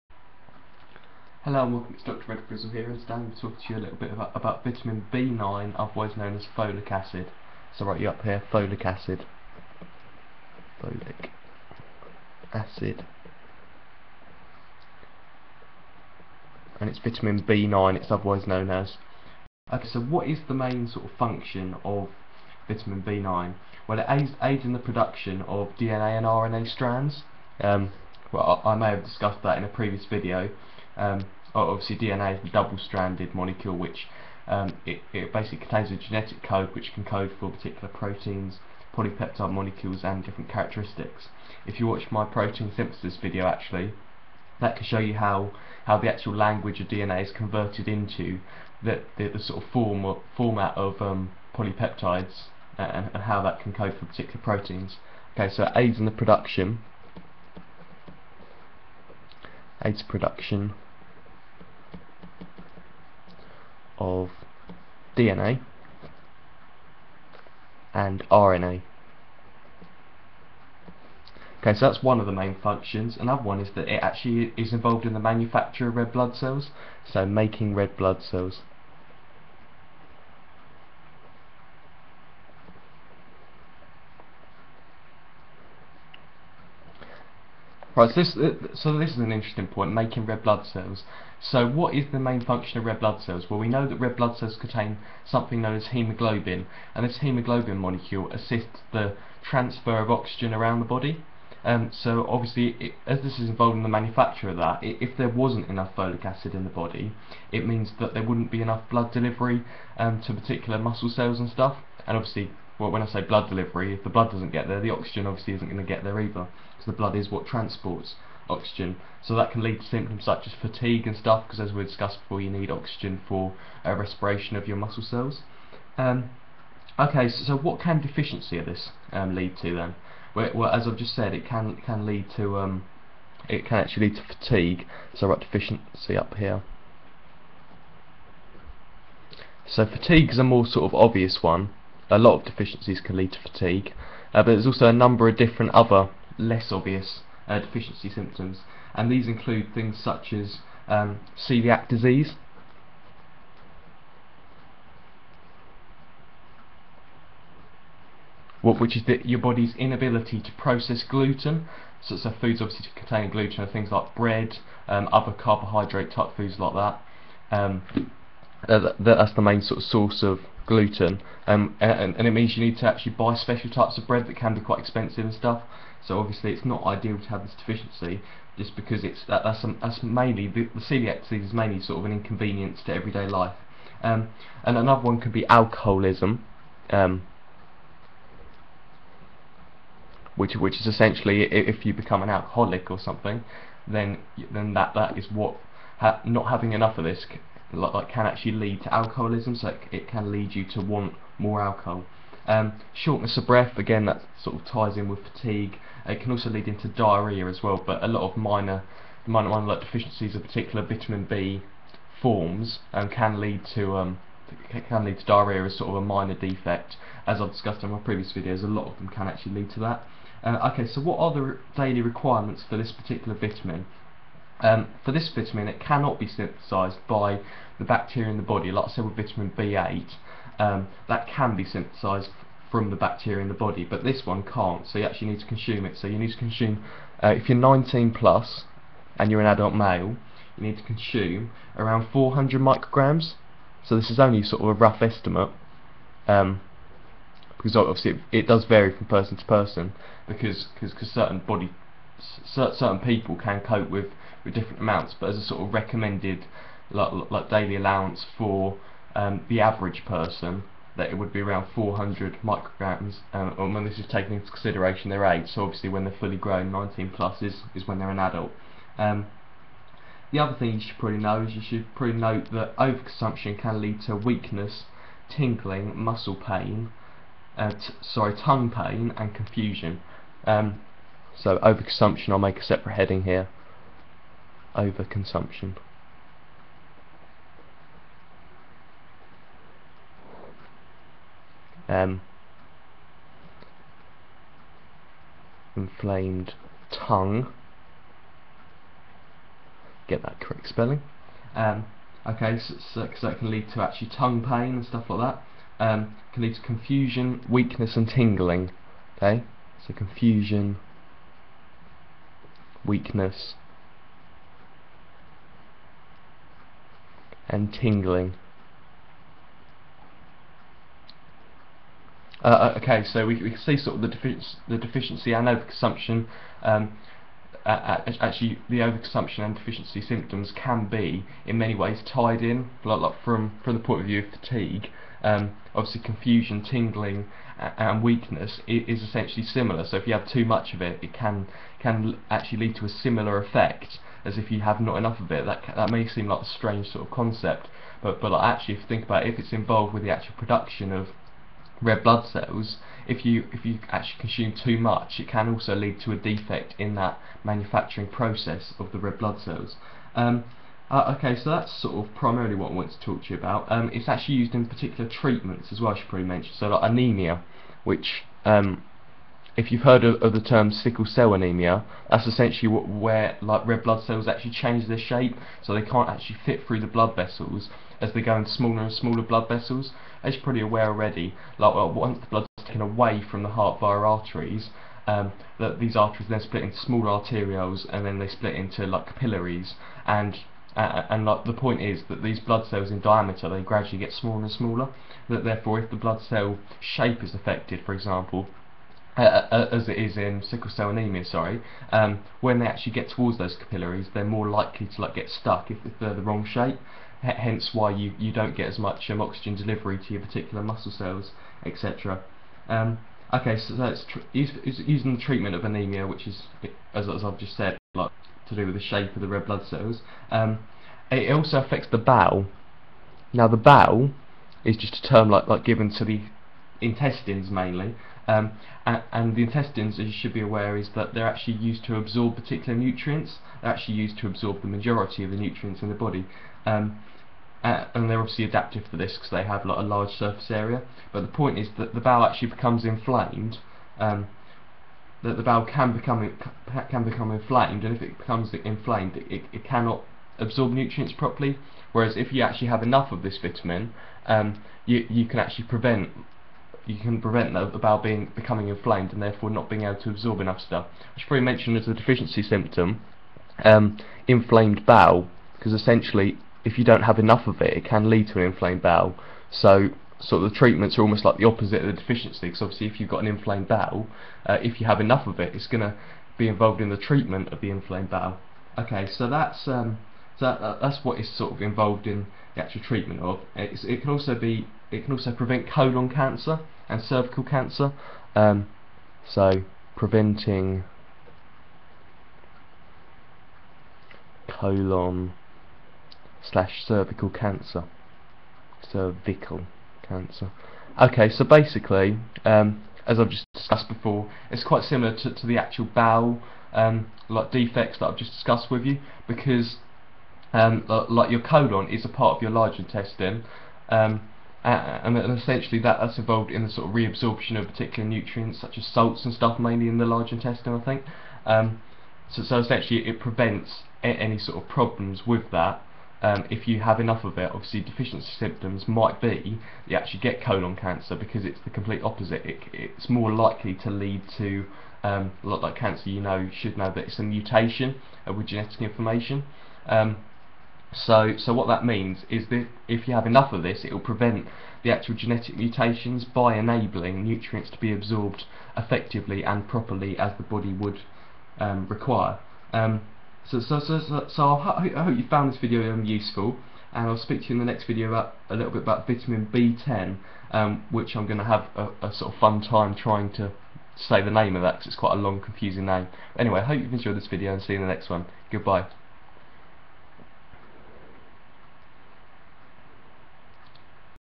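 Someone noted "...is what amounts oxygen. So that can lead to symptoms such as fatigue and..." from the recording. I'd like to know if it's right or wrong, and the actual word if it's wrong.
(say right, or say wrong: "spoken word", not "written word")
wrong: "transports", not "amounts".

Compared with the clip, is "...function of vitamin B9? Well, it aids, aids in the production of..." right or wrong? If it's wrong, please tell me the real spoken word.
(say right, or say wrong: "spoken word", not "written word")
right.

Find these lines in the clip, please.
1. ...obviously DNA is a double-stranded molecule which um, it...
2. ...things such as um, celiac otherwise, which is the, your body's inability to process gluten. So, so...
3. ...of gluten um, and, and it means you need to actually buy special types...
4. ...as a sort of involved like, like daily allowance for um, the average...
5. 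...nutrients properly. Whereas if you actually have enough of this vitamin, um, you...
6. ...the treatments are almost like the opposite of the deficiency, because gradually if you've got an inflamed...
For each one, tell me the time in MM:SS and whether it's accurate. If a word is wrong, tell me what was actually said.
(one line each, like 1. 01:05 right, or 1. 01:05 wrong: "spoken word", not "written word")
1. 00:31 right
2. 02:29 wrong: "disease", not "otherwise"
3. 02:50 right
4. 04:15 wrong: "recommended", not "involved"
5. 07:30 right
6. 07:50 wrong: "obviously", not "gradually".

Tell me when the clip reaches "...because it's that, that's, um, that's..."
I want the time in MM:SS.
02:58.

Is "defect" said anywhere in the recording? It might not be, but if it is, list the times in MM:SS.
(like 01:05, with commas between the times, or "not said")
03:36, 05:56, 08:27.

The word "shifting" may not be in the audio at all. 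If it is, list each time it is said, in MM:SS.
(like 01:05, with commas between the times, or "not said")
not said.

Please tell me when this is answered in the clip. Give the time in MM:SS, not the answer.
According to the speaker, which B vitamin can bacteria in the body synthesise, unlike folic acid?
03:49.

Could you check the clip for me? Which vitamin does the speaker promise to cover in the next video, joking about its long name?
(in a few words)
vitamin B10.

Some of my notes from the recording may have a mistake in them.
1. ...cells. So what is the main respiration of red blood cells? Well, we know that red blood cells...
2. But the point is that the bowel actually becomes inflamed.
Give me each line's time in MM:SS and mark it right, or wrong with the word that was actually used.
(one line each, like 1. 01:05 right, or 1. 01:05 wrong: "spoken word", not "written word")
1. 01:30 wrong: "function", not "respiration"
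2. 07:21 right.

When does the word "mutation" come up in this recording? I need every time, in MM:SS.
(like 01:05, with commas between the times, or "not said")
08:57, 09:05.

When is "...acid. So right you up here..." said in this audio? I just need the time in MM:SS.
00:06.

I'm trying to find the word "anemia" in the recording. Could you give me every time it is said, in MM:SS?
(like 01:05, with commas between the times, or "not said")
06:06, 06:11, 06:40, 06:55.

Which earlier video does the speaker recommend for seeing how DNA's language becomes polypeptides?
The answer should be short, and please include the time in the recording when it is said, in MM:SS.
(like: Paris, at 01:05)
protein synthesis video, at 00:42.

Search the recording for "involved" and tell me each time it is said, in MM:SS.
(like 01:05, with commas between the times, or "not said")
01:14, 01:43, 05:49, 07:56, 08:01, 08:36.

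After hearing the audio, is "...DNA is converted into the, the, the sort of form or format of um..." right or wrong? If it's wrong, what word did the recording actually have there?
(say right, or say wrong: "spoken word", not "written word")
right.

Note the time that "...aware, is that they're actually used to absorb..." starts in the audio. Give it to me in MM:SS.
07:10.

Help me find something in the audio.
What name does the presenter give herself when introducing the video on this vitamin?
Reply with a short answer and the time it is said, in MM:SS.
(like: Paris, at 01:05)
Dr. Red Frizzle, at 00:02.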